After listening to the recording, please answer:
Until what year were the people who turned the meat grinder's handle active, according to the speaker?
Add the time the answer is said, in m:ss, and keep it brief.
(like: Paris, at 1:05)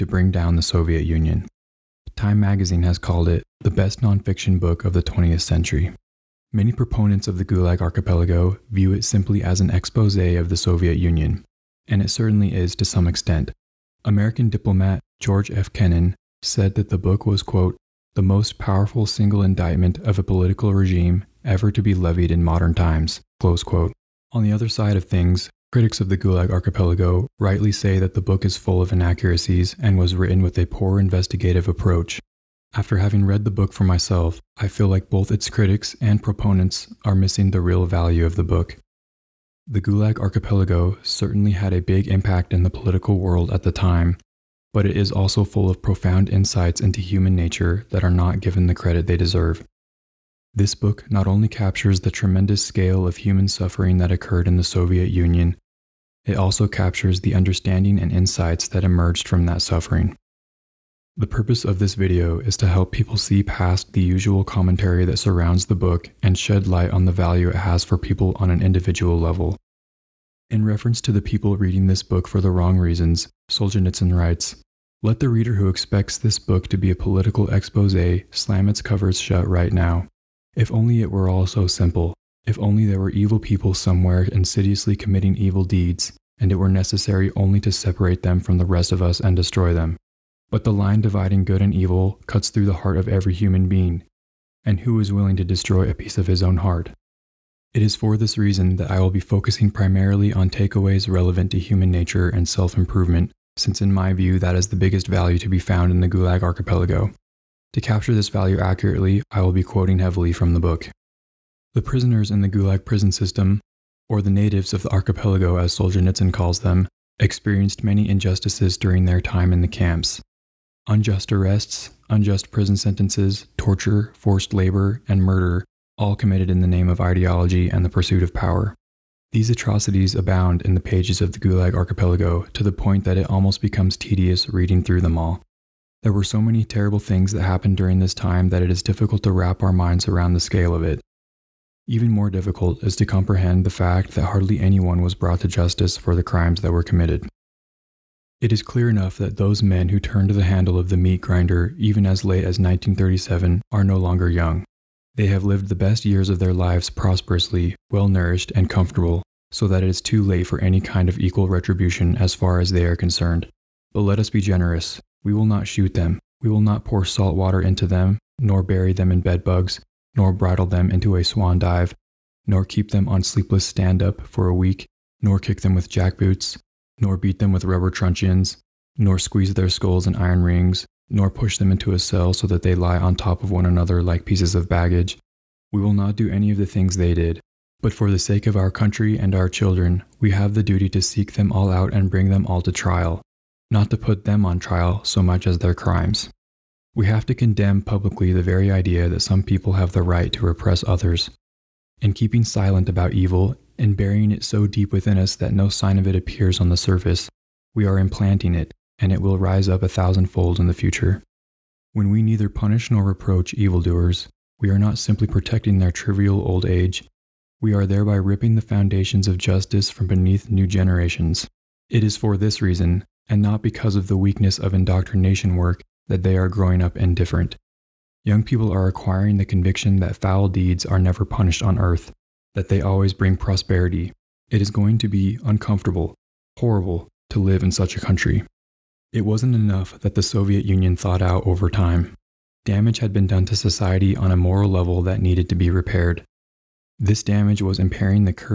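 1937, at 2:32.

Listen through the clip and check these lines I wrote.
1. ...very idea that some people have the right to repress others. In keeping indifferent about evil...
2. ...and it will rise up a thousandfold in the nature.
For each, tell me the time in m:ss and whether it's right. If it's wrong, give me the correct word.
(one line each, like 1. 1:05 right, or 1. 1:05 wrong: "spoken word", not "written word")
1. 3:18 wrong: "silent", not "indifferent"
2. 3:28 wrong: "future", not "nature".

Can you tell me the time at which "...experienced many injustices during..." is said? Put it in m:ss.
1:57.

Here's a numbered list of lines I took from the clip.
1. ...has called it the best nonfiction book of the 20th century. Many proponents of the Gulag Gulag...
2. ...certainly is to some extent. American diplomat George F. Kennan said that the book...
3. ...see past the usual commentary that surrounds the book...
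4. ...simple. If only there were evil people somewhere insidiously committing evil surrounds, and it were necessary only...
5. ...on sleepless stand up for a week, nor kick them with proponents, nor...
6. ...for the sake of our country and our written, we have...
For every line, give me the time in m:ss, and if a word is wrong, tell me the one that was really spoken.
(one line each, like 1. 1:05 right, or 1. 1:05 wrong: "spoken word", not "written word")
1. 0:02 wrong: "Archipelago", not "Gulag"
2. 0:12 right
3. 1:03 right
4. 1:21 wrong: "deeds", not "surrounds"
5. 2:53 wrong: "jackboots", not "proponents"
6. 3:07 wrong: "children", not "written".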